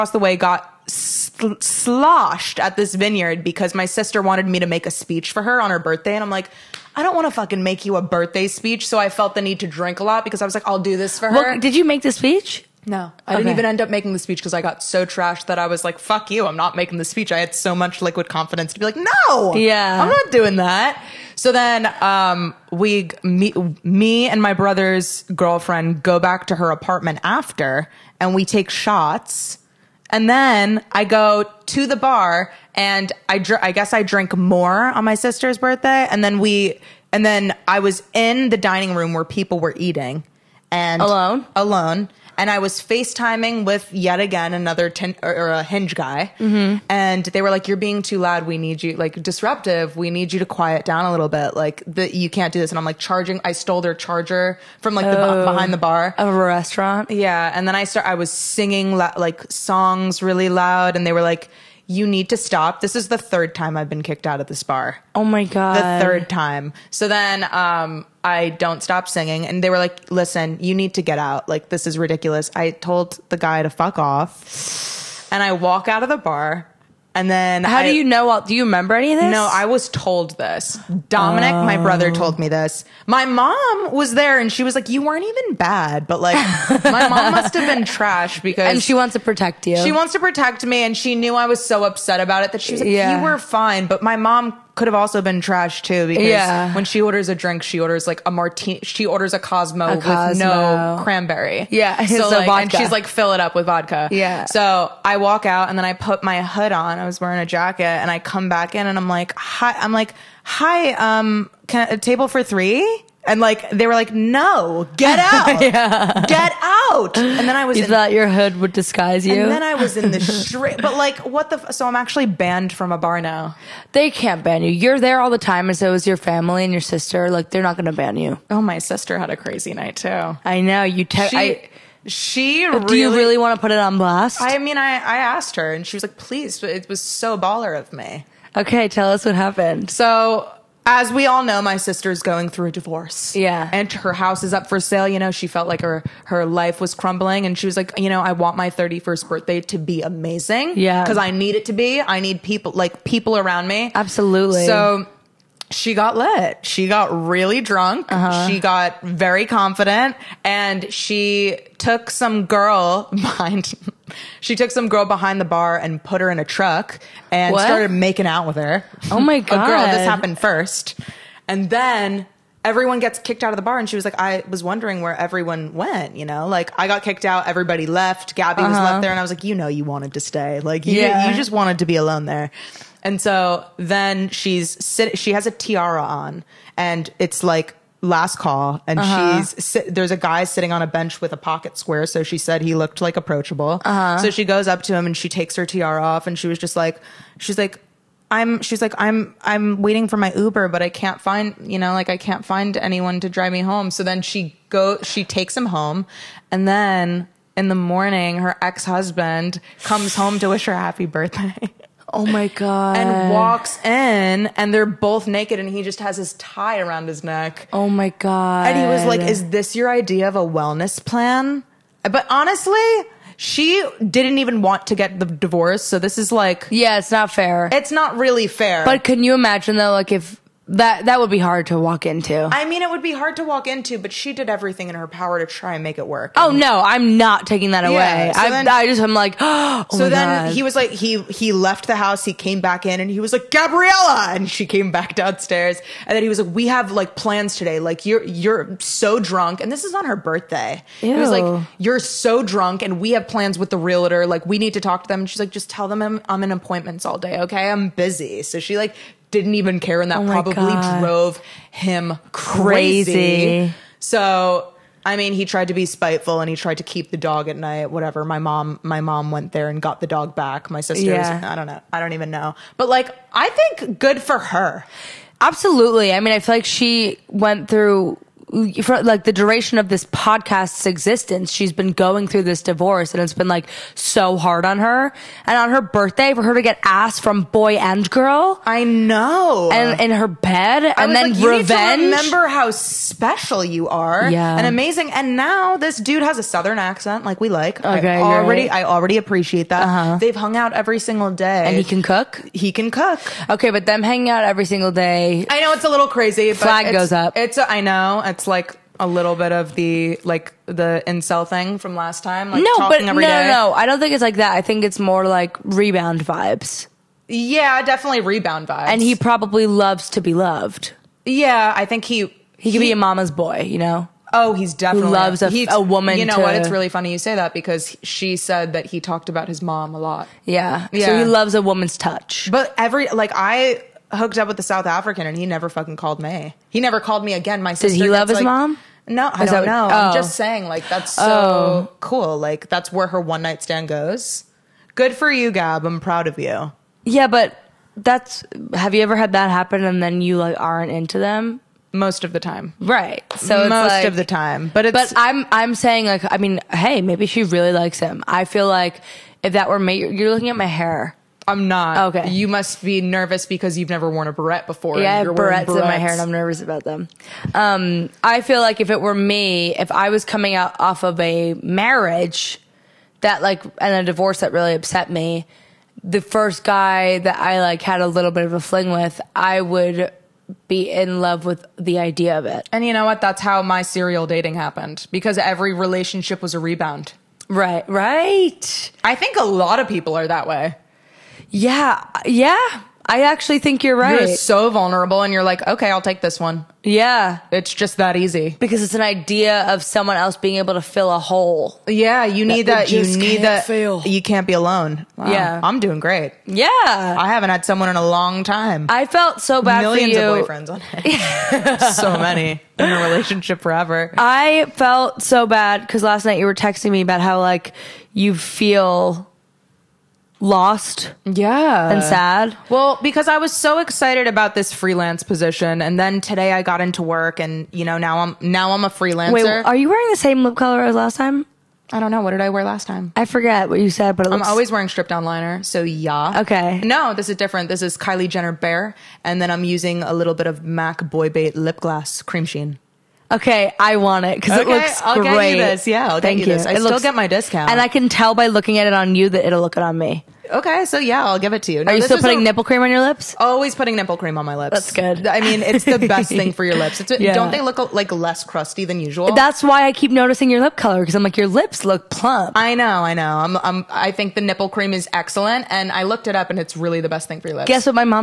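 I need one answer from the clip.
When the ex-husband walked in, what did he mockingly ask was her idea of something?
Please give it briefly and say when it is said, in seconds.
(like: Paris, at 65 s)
wellness plan, at 220 s.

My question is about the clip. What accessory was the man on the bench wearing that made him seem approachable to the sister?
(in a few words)
pocket square.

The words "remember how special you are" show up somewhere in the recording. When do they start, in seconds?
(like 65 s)
292 s.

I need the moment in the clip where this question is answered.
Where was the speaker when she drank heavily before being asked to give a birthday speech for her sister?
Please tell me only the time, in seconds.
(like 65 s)
2 s.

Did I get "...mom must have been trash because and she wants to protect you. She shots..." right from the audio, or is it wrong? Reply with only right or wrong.
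wrong.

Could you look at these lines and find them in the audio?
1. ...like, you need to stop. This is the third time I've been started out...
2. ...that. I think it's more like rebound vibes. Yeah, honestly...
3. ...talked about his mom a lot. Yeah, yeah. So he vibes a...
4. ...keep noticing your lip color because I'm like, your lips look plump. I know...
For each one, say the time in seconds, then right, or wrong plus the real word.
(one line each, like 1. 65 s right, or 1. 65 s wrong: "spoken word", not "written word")
1. 61 s wrong: "kicked", not "started"
2. 314 s wrong: "definitely", not "honestly"
3. 329 s wrong: "loves", not "vibes"
4. 459 s right.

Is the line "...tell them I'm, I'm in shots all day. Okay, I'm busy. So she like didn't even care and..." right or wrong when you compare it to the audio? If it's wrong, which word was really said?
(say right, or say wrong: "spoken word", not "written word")
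wrong: "appointments", not "shots".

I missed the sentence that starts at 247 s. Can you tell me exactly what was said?
Like you're you're so drunk, and this is on her birthday.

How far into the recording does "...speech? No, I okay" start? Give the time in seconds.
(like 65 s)
12 s.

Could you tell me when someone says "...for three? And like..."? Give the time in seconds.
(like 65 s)
112 s.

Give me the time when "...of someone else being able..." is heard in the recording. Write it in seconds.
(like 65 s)
399 s.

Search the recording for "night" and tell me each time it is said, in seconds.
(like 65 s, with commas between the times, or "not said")
129 s, 267 s, 343 s, 416 s.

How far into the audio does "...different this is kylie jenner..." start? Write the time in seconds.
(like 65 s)
437 s.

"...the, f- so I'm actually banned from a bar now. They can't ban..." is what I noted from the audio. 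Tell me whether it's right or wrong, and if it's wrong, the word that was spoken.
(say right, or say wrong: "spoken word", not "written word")
right.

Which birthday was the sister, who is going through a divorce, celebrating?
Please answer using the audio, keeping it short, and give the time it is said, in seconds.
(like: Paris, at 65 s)
31st, at 148 s.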